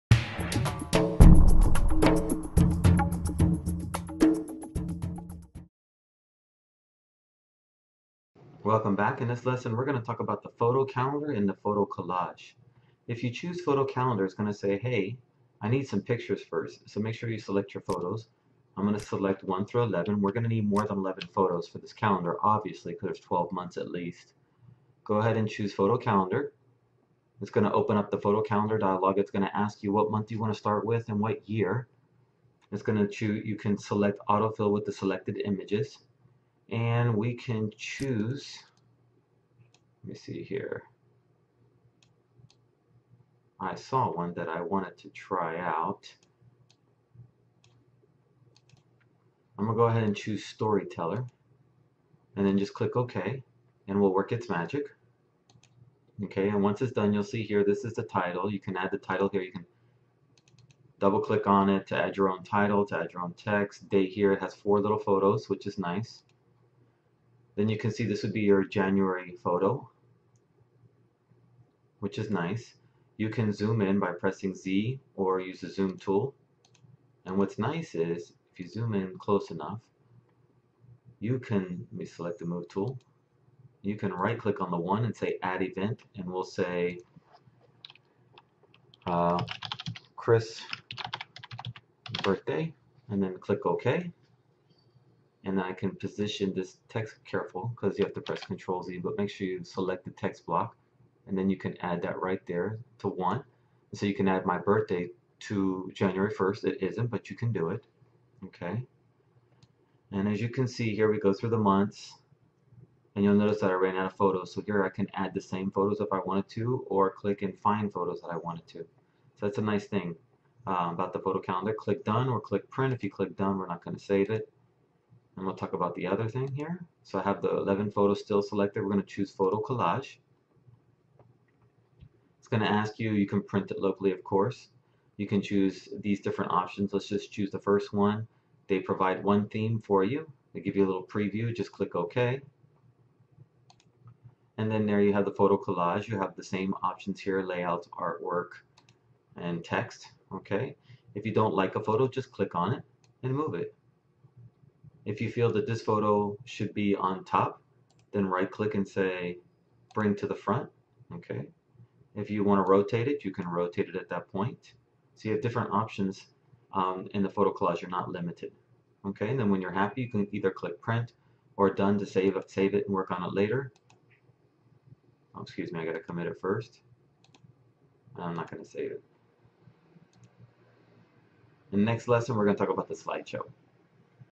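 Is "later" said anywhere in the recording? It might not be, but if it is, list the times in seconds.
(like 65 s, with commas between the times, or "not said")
173 s.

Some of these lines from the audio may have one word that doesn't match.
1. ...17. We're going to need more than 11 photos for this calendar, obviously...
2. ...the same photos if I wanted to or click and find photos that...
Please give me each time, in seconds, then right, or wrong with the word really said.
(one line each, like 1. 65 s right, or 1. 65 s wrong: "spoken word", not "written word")
1. 19 s wrong: "11", not "17"
2. 115 s right.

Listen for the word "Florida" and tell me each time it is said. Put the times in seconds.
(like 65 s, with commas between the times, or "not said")
not said.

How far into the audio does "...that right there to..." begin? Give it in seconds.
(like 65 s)
102 s.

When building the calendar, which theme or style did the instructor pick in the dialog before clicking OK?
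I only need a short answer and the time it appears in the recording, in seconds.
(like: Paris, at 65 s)
Storyteller, at 50 s.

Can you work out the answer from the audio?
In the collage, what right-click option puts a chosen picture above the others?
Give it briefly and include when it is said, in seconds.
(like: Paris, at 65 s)
Bring to the front, at 159 s.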